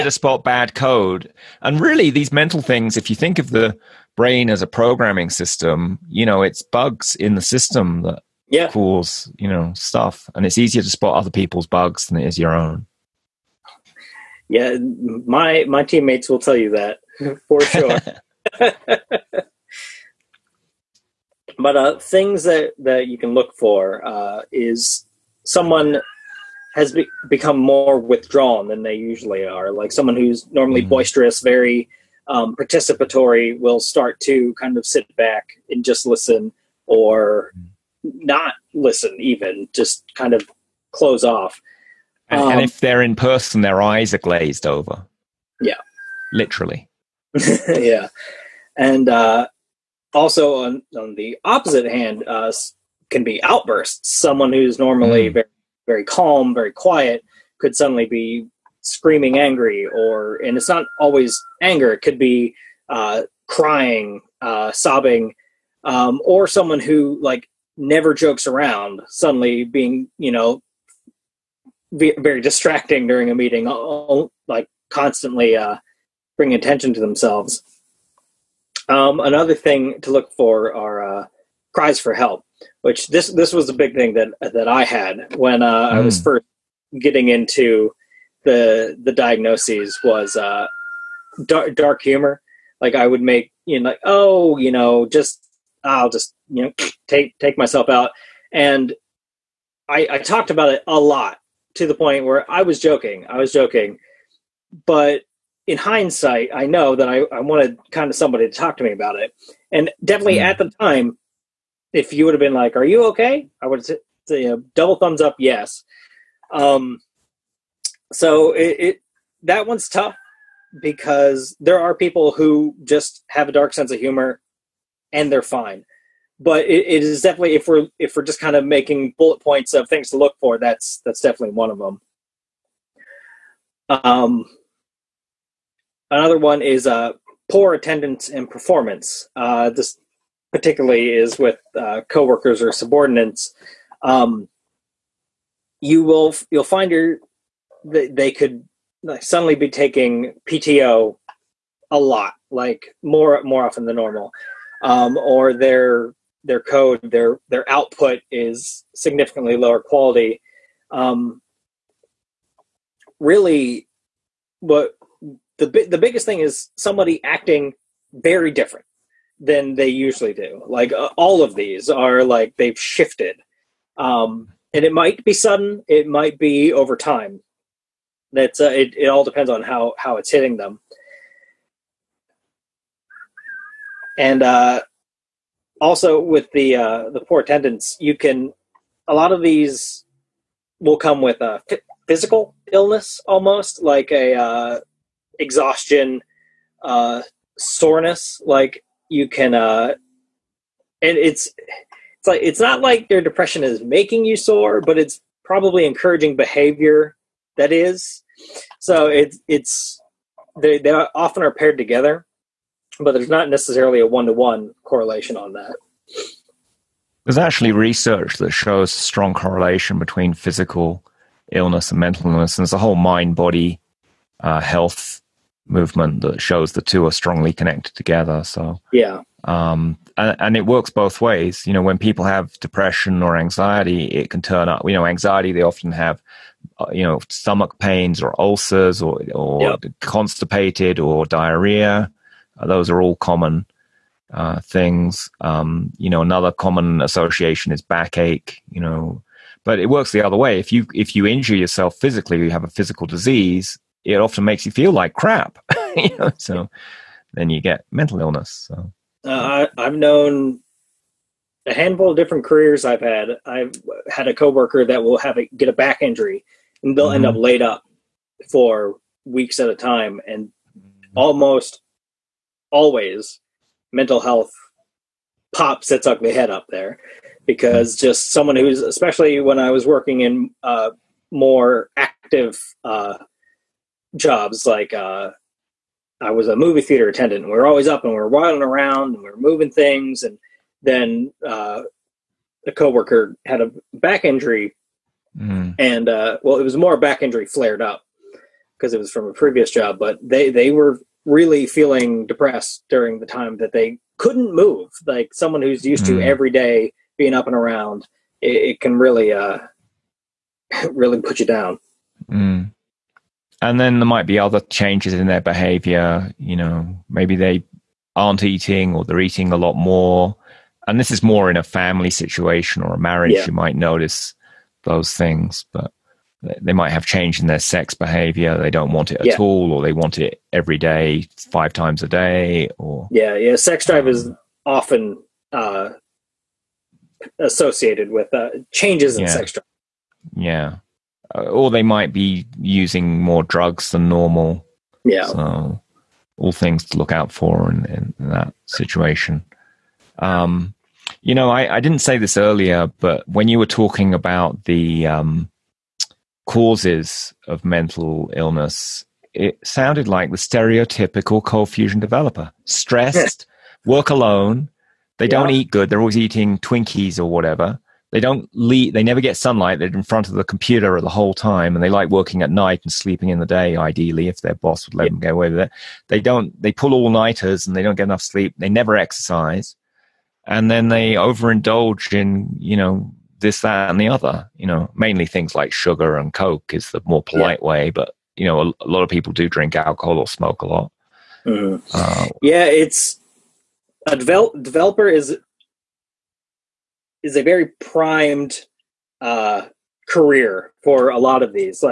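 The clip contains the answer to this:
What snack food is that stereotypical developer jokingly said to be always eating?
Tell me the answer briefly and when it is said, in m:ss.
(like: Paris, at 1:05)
Twinkies, at 6:06.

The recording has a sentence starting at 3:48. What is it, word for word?
So yeah, um, and, and, it works both ways.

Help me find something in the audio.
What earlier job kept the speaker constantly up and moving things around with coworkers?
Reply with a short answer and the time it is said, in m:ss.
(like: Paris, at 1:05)
movie theater attendant, at 4:46.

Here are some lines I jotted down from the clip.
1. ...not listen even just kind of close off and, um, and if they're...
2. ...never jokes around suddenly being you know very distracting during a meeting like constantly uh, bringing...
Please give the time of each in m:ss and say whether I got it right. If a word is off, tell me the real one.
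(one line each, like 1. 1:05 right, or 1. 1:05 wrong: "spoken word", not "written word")
1. 0:38 right
2. 1:07 right.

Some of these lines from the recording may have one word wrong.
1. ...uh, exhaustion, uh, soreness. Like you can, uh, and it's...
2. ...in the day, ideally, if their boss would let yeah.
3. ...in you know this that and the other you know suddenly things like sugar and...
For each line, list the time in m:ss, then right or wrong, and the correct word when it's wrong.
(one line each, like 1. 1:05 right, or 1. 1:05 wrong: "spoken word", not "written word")
1. 3:14 right
2. 6:13 right
3. 6:22 wrong: "mainly", not "suddenly".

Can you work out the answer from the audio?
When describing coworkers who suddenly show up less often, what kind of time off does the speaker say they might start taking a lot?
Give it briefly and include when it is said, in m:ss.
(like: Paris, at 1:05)
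PTO, at 2:30.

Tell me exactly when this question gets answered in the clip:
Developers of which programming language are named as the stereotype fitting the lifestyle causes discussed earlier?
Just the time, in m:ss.
6:01.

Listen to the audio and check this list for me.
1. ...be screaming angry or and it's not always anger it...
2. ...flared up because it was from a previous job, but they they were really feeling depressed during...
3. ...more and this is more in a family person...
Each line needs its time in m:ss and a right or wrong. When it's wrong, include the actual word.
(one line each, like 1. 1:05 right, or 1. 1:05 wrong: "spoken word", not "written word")
1. 0:58 right
2. 4:57 right
3. 5:19 wrong: "situation", not "person".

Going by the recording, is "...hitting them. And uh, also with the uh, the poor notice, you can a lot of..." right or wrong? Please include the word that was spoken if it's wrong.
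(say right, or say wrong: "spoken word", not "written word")
wrong: "attendance", not "notice".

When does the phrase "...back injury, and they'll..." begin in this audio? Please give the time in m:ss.
4:25.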